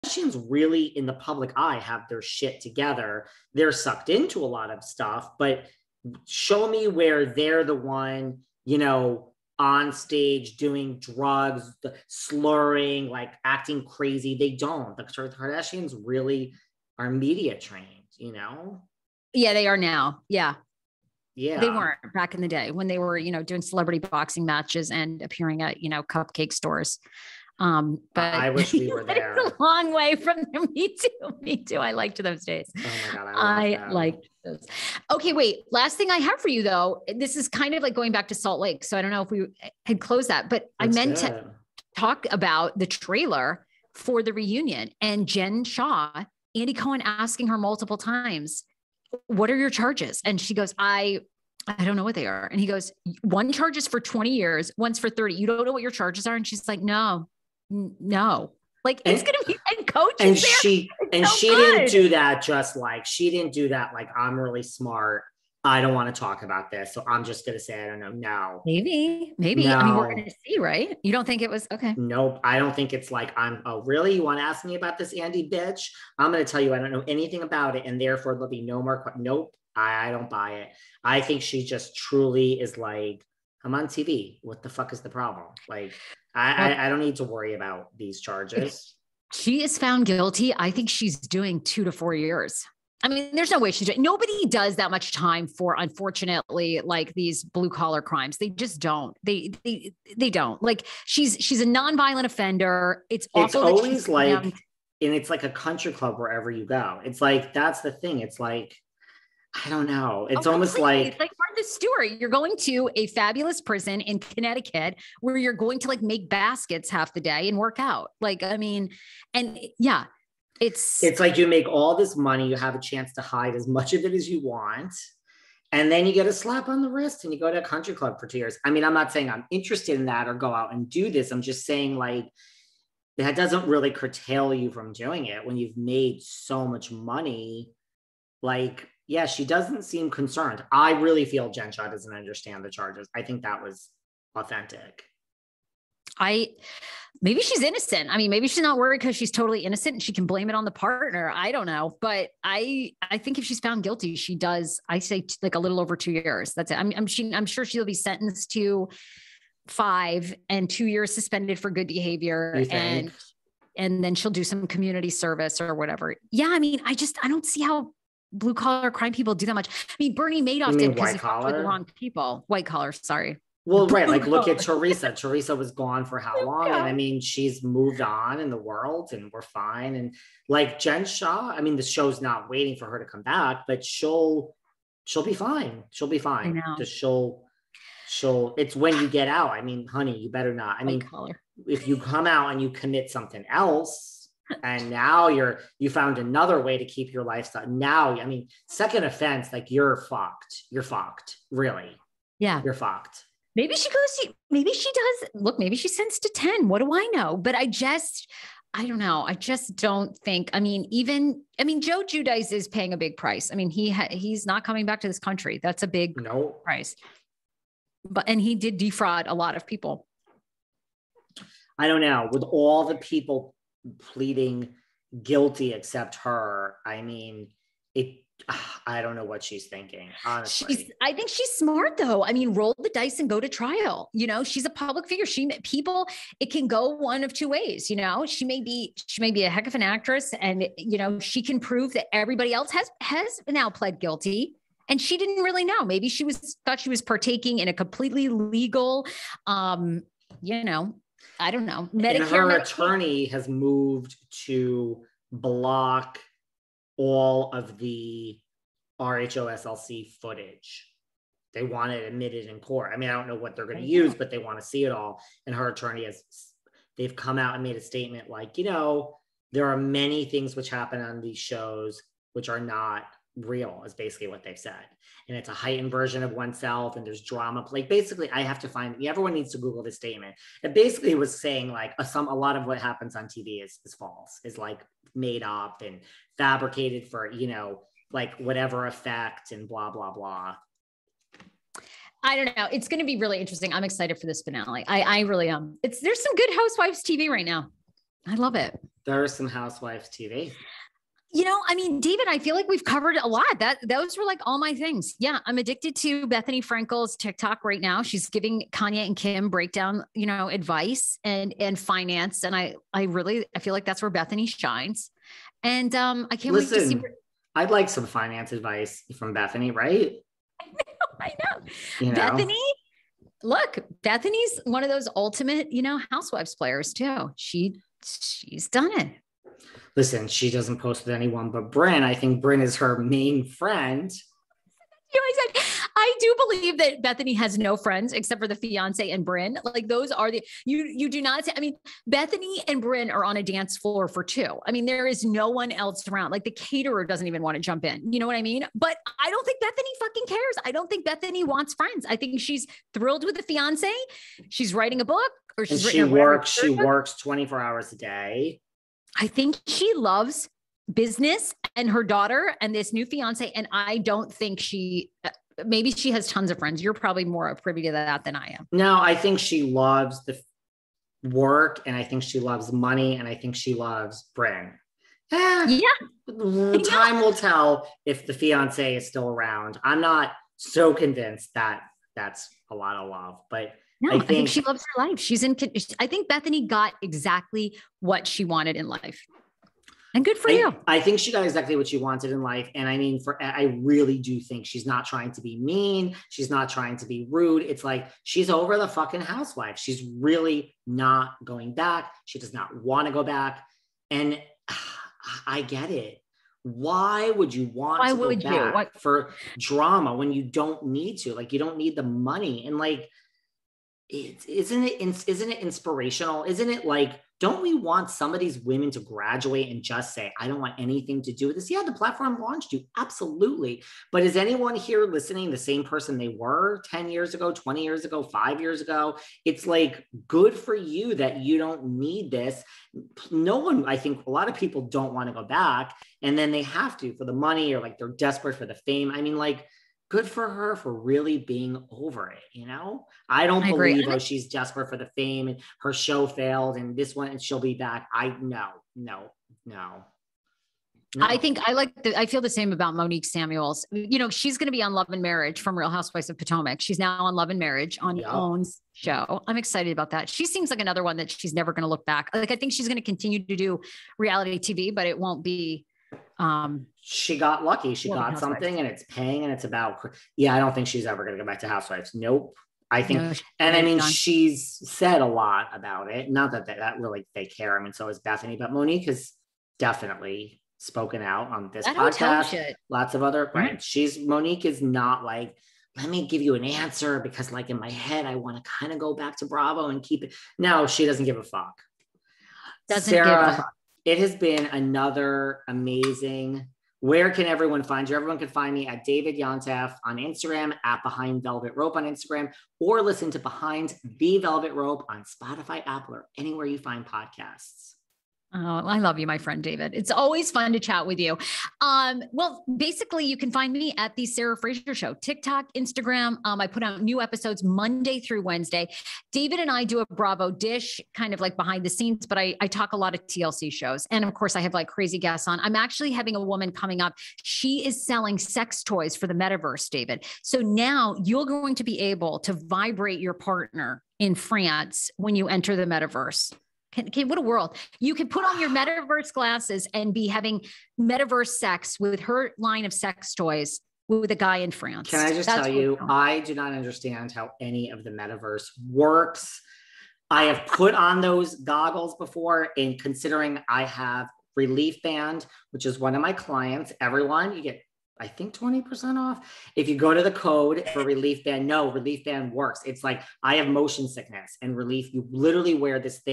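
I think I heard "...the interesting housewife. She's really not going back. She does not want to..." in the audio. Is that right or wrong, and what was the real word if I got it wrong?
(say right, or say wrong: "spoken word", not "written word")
wrong: "fucking", not "interesting".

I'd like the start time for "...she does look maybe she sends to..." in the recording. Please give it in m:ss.
3:24.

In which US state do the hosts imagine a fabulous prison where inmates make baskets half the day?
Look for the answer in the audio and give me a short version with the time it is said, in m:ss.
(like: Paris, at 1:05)
Connecticut, at 1:54.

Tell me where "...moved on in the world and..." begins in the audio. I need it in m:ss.
2:57.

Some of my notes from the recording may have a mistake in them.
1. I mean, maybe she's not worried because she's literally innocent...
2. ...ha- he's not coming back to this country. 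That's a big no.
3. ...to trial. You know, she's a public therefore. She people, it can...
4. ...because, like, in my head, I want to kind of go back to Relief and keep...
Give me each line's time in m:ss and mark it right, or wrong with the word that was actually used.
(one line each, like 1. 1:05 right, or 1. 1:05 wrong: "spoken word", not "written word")
1. 2:28 wrong: "totally", not "literally"
2. 3:33 right
3. 3:53 wrong: "figure", not "therefore"
4. 8:07 wrong: "Bravo", not "Relief".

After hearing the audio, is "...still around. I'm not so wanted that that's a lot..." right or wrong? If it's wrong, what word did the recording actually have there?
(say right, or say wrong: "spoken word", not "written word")
wrong: "convinced", not "wanted".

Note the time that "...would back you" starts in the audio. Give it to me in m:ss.
6:48.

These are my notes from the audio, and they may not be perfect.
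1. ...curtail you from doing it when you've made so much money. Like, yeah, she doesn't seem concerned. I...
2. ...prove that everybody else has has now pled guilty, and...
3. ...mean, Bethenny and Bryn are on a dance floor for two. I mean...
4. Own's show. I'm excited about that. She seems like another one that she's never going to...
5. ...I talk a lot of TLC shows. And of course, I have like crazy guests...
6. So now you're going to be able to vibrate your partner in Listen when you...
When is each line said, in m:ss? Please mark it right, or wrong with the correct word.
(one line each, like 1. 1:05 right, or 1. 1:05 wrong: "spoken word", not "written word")
1. 2:13 right
2. 4:01 right
3. 5:41 right
4. 7:38 right
5. 8:42 right
6. 8:50 wrong: "France", not "Listen".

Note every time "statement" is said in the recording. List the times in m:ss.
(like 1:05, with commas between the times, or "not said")
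4:27, 4:39.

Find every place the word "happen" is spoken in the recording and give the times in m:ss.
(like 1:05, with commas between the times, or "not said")
4:30, 4:42.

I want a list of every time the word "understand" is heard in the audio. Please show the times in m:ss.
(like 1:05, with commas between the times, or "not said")
2:22, 9:06.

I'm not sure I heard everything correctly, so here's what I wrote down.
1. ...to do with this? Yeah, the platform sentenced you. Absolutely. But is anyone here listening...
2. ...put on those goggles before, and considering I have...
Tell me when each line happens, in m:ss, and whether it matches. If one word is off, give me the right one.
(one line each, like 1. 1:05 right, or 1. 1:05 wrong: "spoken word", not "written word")
1. 7:01 wrong: "launched", not "sentenced"
2. 9:10 right.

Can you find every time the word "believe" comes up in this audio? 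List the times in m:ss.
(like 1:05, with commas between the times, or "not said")
5:36, 7:23.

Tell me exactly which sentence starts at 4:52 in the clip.
It's going to be really interesting.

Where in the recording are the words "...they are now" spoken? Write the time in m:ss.
0:19.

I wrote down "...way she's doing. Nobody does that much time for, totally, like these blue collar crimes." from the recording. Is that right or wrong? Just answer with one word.
wrong.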